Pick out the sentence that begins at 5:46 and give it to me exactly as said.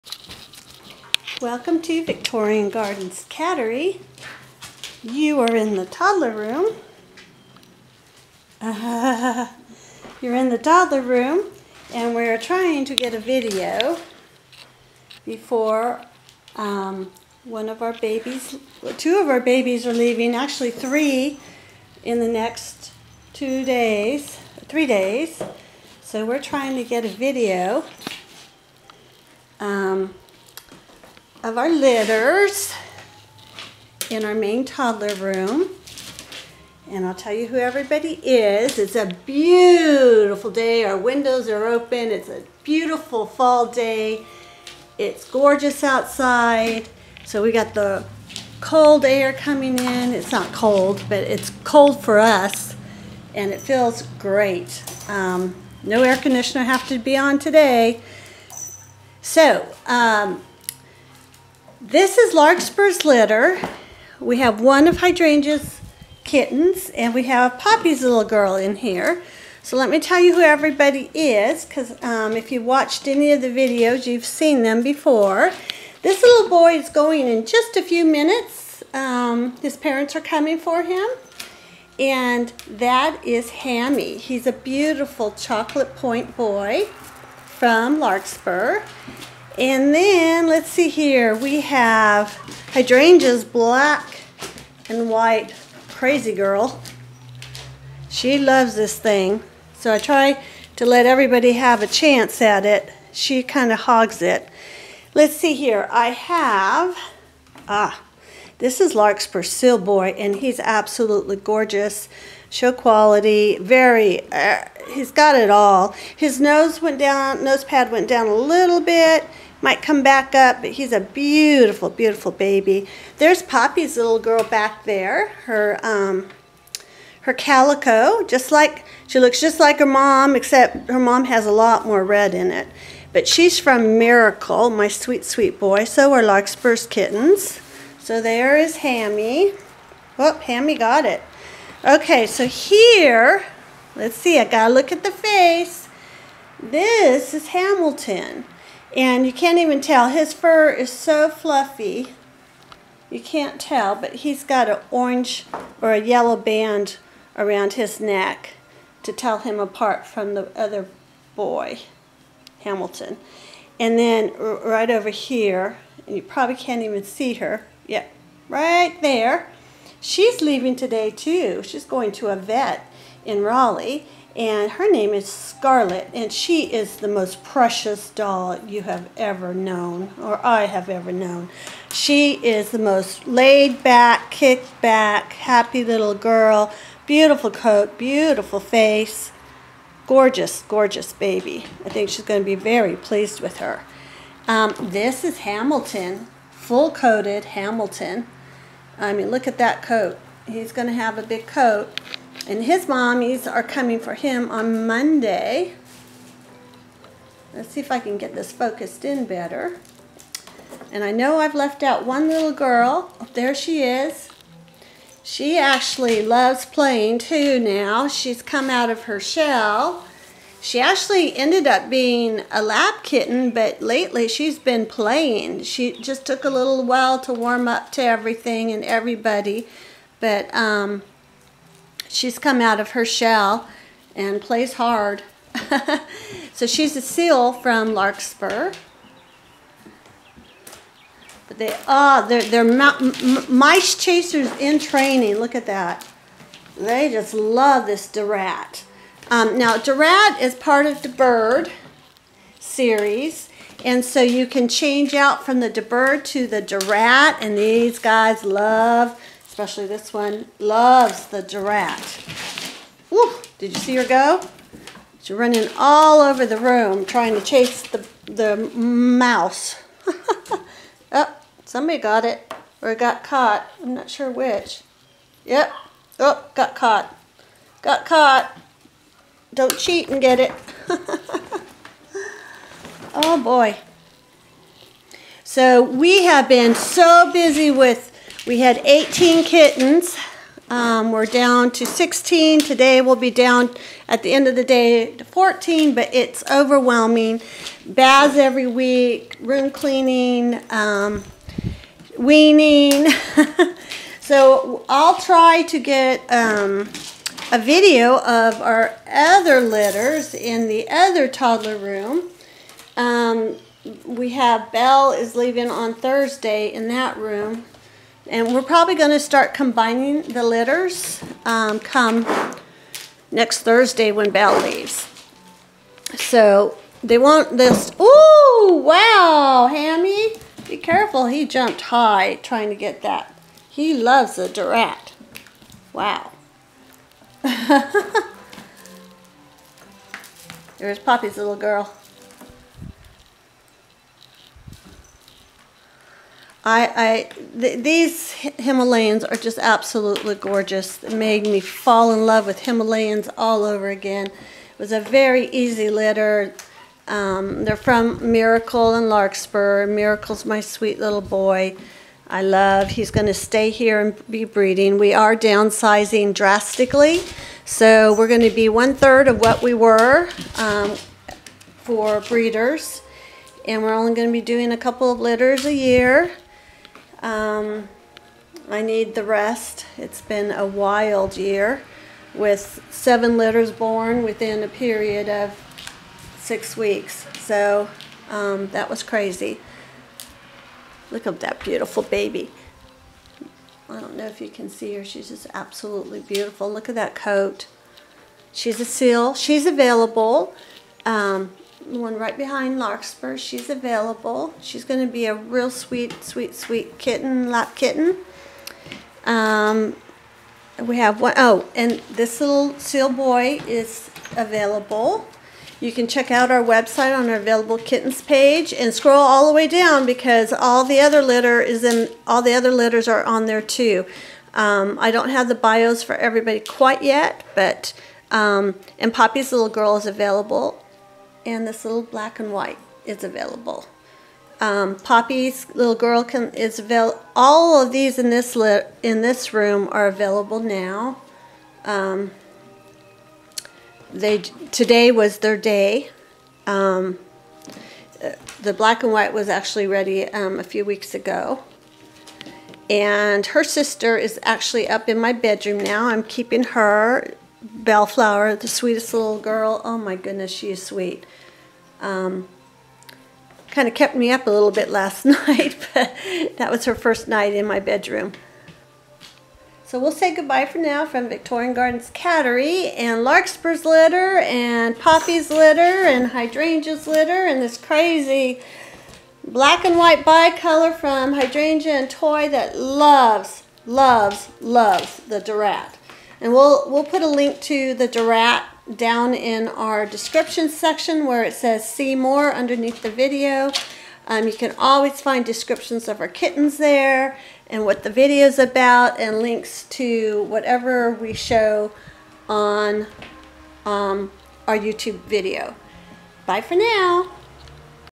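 I, I th these Himalayans are just absolutely gorgeous.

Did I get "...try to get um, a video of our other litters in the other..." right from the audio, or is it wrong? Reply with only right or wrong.
right.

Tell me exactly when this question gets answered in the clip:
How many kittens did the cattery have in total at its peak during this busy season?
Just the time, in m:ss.
4:48.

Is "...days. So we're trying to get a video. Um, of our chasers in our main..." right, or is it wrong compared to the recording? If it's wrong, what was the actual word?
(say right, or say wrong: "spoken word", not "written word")
wrong: "litters", not "chasers".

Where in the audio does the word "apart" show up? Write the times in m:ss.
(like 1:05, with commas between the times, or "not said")
2:39.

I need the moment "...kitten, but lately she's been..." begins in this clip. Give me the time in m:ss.
3:43.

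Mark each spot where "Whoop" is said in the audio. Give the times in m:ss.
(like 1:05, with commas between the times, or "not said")
2:20.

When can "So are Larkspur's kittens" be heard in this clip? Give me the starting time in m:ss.
2:15.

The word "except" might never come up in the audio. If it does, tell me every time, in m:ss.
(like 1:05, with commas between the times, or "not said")
2:10.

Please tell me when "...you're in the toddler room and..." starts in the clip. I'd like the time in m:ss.
0:10.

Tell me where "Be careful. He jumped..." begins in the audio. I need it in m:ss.
5:30.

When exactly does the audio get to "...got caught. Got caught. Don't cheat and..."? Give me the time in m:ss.
4:36.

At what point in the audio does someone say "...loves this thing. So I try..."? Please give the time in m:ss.
1:38.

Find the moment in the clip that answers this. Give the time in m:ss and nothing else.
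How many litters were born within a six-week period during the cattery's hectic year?
6:22.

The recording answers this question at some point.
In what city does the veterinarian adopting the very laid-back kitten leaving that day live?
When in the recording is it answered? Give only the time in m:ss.
2:53.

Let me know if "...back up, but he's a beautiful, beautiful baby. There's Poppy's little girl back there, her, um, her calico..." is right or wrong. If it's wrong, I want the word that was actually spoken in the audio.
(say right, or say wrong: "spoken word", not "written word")
right.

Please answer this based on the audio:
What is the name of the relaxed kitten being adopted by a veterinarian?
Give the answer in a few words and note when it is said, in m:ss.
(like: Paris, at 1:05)
Scarlet, at 2:55.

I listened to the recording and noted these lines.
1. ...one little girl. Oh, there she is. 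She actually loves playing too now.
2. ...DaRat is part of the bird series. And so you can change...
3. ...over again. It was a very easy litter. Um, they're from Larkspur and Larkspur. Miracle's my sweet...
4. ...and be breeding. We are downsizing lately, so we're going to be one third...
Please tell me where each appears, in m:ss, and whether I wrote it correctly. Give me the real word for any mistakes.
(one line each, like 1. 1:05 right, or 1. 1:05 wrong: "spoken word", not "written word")
1. 3:32 right
2. 4:09 right
3. 5:53 wrong: "Miracle", not "Larkspur"
4. 6:03 wrong: "drastically", not "lately".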